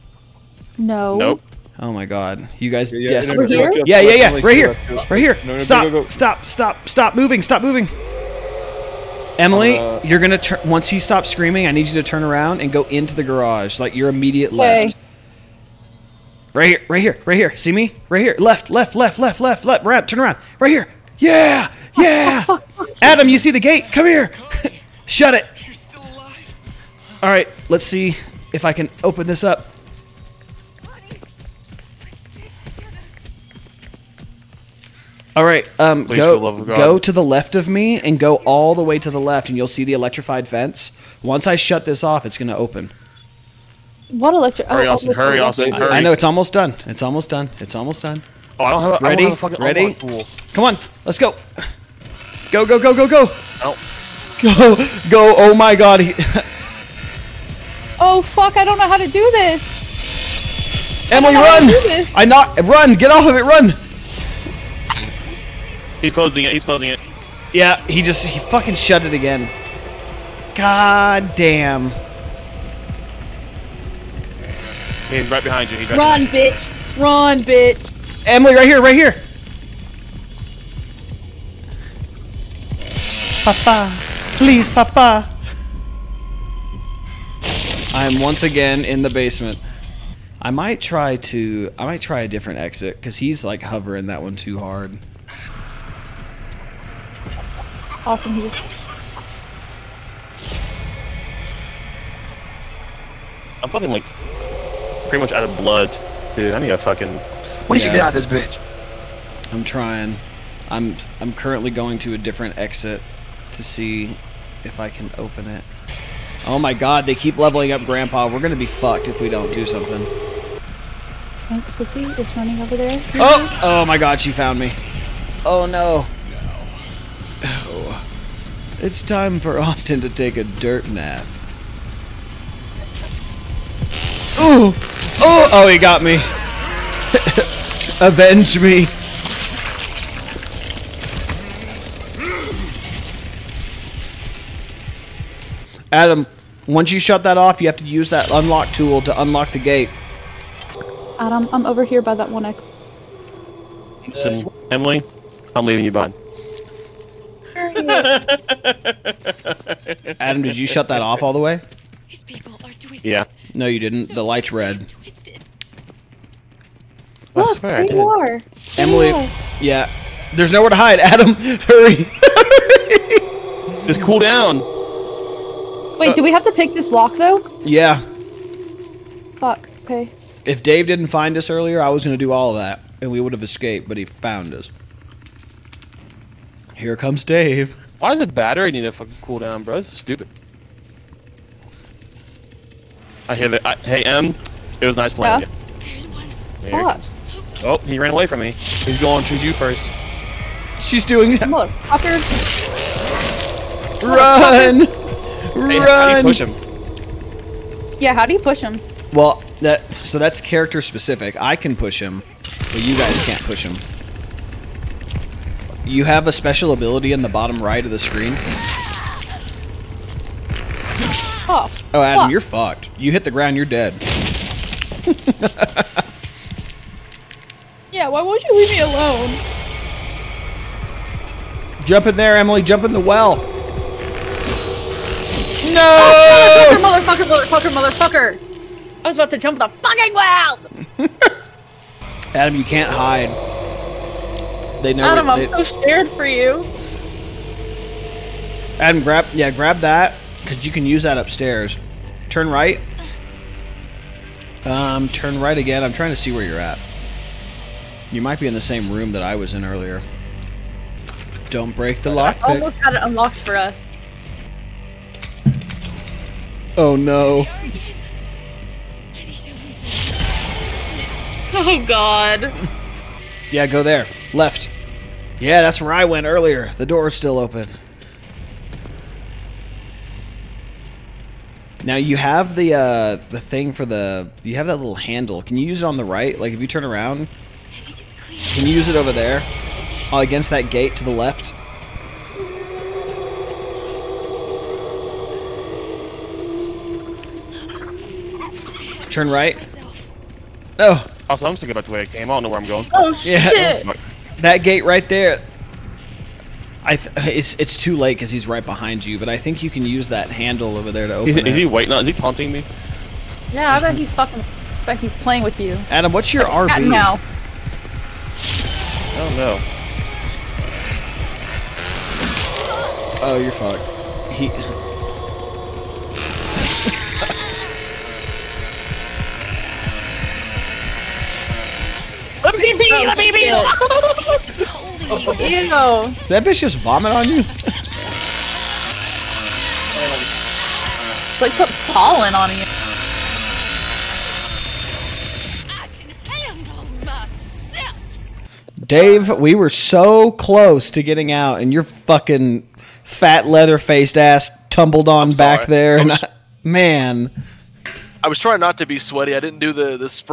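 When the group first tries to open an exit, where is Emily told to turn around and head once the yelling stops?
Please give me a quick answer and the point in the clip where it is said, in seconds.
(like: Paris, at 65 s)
the garage, at 13 s.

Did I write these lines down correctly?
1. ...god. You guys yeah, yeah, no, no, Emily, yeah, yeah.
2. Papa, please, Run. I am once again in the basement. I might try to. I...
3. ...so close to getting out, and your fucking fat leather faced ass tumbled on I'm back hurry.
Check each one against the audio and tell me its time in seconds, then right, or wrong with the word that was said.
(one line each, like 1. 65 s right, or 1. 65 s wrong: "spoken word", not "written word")
1. 2 s wrong: "Yeah", not "Emily"
2. 83 s wrong: "Papa", not "Run"
3. 349 s wrong: "sorry", not "hurry".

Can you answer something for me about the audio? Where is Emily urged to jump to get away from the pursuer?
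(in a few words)
the well.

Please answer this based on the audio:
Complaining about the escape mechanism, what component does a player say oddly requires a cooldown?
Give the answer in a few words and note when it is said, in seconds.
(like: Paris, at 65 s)
the battery, at 188 s.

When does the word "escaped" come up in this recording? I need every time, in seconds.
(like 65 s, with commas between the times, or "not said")
183 s.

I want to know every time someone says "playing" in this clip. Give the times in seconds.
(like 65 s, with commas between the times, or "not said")
195 s, 315 s.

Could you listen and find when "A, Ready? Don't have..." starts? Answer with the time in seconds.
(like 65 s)
48 s.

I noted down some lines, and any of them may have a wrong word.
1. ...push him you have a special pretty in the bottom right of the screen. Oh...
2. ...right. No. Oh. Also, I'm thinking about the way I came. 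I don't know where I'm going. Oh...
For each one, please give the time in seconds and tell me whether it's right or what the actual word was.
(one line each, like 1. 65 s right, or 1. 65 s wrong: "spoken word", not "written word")
1. 213 s wrong: "ability", not "pretty"
2. 299 s right.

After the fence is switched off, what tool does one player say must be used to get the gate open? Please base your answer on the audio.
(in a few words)
unlock tool.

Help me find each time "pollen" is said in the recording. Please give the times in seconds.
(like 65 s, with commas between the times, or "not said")
341 s.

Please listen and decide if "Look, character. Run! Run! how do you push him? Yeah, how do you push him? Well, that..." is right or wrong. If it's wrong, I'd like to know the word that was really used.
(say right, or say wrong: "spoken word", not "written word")
wrong: "fucker", not "character".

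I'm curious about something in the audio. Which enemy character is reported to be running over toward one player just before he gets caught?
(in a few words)
Sissy.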